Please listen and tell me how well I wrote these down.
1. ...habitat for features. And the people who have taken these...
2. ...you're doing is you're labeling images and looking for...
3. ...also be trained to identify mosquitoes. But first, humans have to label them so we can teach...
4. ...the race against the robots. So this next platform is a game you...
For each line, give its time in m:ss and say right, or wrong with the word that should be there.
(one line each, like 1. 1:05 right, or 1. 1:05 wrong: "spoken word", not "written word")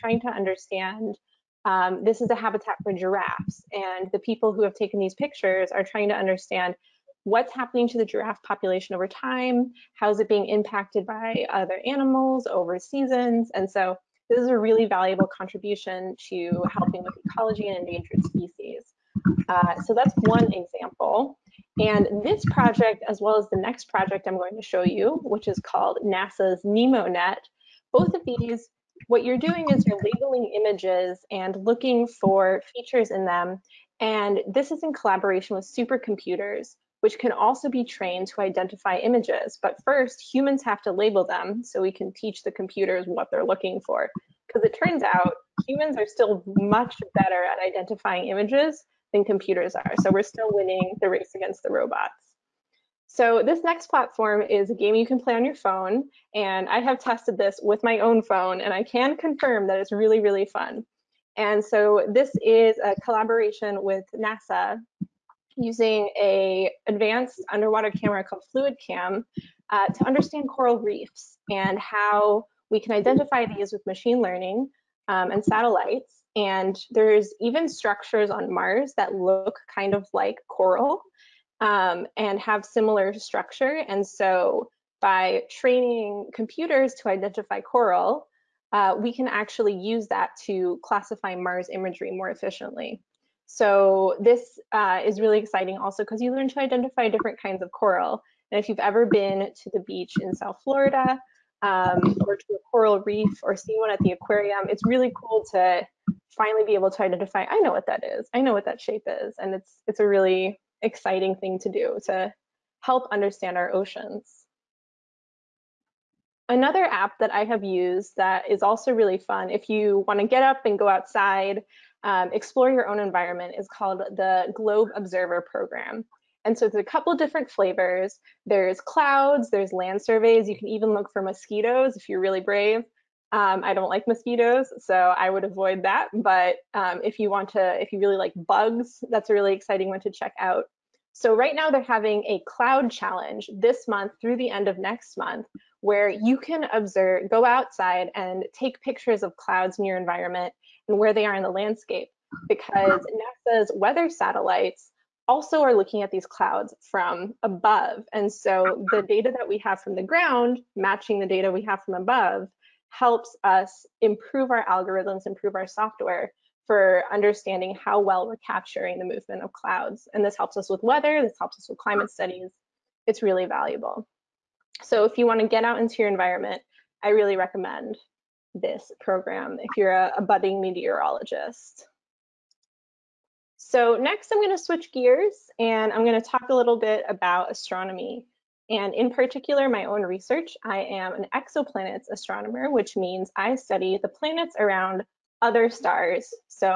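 1. 0:02 wrong: "giraffes", not "features"
2. 0:29 right
3. 0:37 wrong: "images", not "mosquitoes"
4. 0:50 right.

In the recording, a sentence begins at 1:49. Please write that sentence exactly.
And it's, it's a really exciting thing to do to help understand our oceans.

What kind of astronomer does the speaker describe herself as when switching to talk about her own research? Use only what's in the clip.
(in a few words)
Exoplanets astronomer.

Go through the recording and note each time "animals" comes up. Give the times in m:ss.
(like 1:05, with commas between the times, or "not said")
0:11.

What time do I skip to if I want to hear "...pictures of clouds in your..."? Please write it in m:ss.
2:28.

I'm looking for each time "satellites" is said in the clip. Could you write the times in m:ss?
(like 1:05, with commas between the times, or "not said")
1:15, 2:34.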